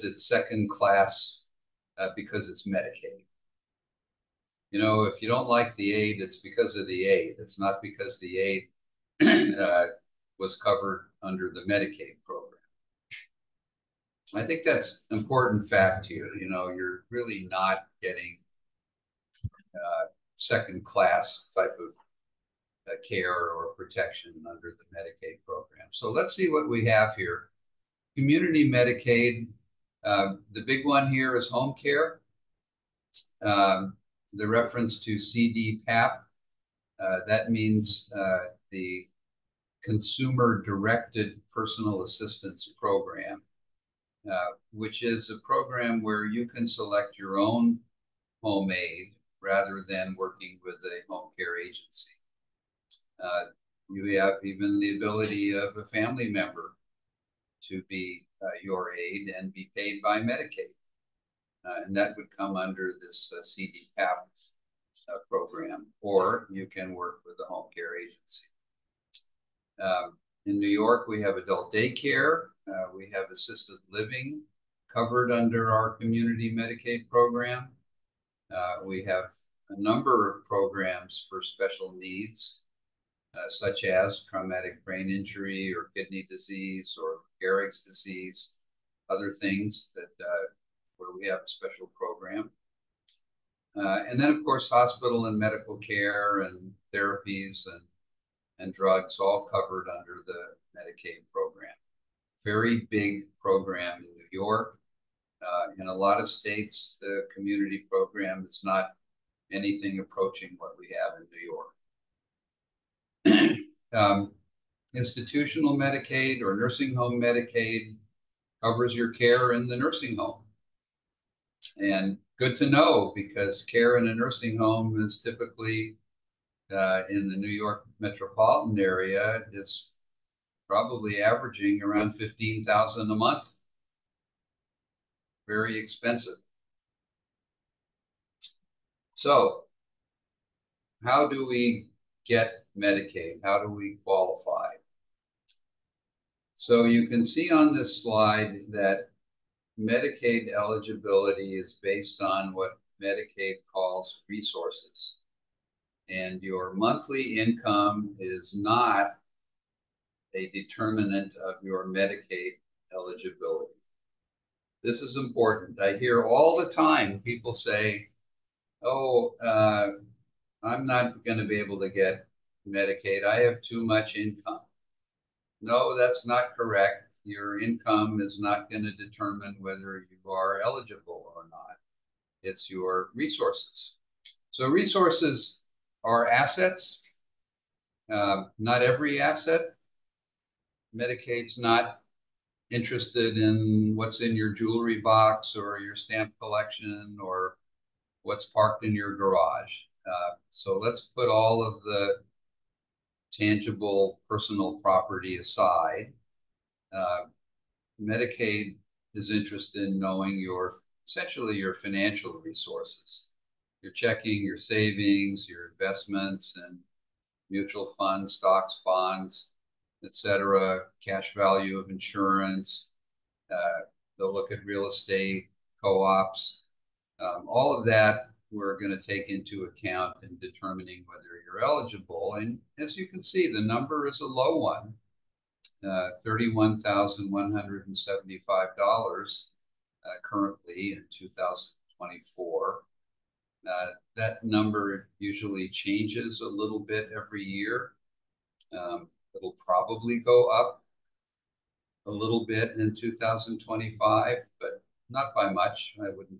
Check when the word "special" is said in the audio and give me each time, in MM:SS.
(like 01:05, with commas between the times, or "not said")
01:21, 01:31.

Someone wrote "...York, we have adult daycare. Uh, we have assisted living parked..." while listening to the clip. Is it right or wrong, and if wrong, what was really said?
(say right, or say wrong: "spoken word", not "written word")
wrong: "covered", not "parked".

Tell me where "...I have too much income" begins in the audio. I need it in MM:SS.
02:53.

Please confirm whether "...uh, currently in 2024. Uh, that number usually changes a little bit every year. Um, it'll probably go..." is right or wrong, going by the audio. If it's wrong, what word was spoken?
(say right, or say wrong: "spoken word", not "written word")
right.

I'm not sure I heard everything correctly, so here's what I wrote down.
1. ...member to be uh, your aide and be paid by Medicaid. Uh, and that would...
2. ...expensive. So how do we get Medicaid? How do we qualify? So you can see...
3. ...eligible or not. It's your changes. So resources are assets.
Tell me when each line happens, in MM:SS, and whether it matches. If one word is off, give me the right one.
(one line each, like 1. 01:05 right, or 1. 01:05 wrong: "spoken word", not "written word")
1. 00:56 right
2. 02:15 right
3. 03:00 wrong: "resources", not "changes".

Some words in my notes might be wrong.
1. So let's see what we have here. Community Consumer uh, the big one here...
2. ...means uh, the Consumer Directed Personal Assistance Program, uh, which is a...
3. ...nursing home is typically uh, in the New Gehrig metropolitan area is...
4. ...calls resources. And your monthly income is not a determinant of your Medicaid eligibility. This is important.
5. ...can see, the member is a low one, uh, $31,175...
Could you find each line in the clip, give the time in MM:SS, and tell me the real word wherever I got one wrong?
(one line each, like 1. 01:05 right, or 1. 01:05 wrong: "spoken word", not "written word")
1. 00:25 wrong: "Medicaid", not "Consumer"
2. 00:37 right
3. 02:04 wrong: "York", not "Gehrig"
4. 02:33 right
5. 03:53 wrong: "number", not "member".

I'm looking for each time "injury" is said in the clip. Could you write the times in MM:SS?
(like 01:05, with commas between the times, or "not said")
01:25.